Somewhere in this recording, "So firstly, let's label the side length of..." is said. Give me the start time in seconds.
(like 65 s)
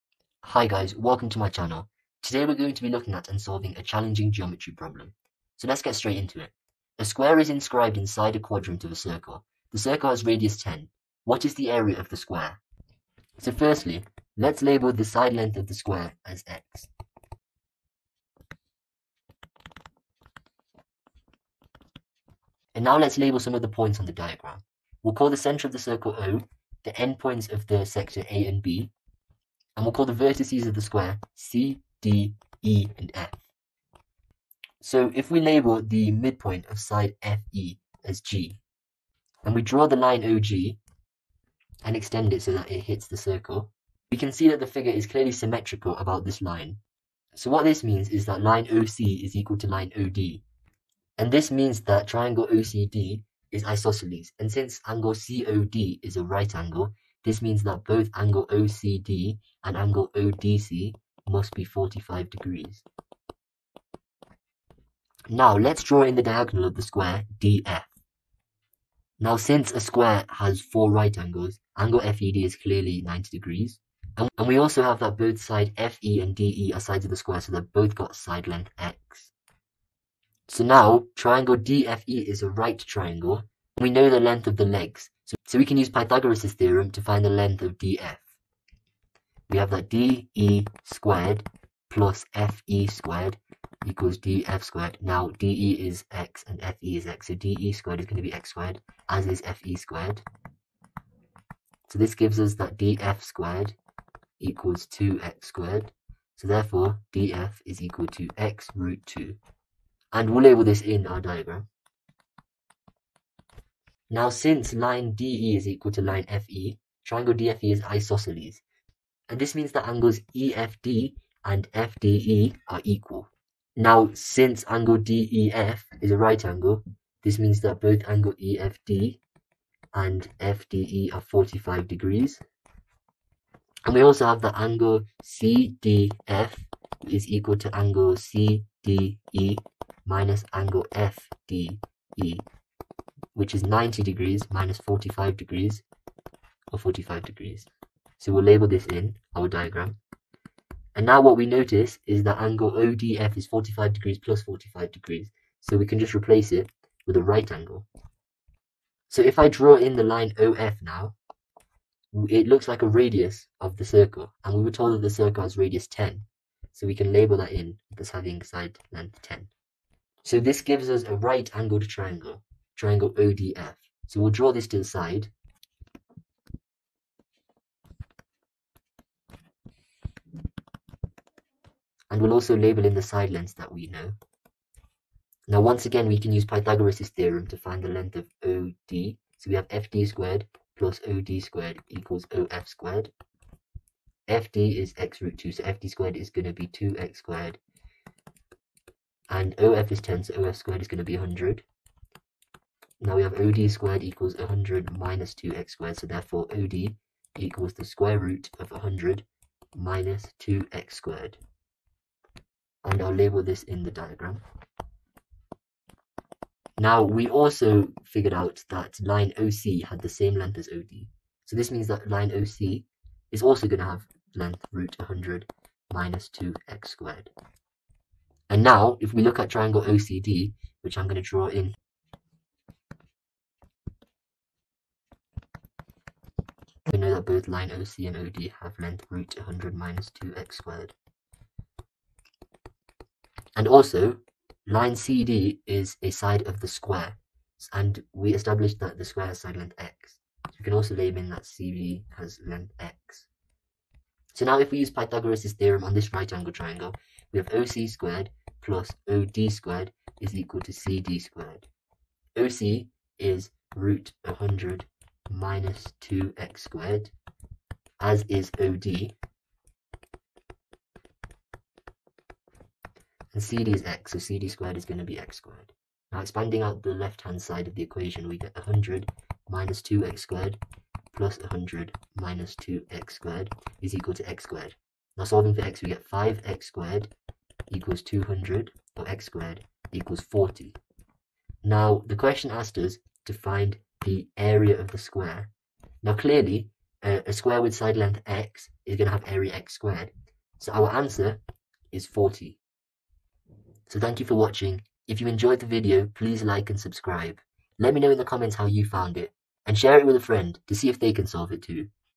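13 s.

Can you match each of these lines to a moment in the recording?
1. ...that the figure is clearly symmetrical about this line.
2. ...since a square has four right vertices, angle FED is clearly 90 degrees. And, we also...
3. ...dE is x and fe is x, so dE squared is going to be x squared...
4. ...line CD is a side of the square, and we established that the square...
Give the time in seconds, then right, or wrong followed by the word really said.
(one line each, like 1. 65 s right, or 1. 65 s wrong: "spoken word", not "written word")
1. 44 s right
2. 69 s wrong: "angles", not "vertices"
3. 95 s right
4. 244 s right.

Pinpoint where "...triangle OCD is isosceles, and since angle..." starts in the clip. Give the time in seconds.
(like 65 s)
52 s.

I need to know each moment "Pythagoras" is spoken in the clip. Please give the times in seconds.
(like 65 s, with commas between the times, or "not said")
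85 s, 186 s, 254 s.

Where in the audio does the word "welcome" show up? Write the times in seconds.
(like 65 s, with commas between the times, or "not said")
0 s.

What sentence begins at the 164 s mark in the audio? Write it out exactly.
And we were told that the circle has radius 10.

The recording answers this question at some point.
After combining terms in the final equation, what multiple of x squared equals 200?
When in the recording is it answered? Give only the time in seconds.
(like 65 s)
286 s.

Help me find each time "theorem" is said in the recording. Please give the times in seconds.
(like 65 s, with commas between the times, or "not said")
86 s, 187 s, 255 s.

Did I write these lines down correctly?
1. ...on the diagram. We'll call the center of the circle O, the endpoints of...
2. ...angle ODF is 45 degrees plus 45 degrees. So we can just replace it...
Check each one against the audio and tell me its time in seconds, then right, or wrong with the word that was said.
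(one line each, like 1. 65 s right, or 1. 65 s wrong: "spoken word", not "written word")
1. 24 s right
2. 152 s right.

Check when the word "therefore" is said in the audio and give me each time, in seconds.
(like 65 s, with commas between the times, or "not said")
106 s, 206 s.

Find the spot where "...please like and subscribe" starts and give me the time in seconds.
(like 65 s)
306 s.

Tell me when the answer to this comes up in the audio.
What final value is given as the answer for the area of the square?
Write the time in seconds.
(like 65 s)
300 s.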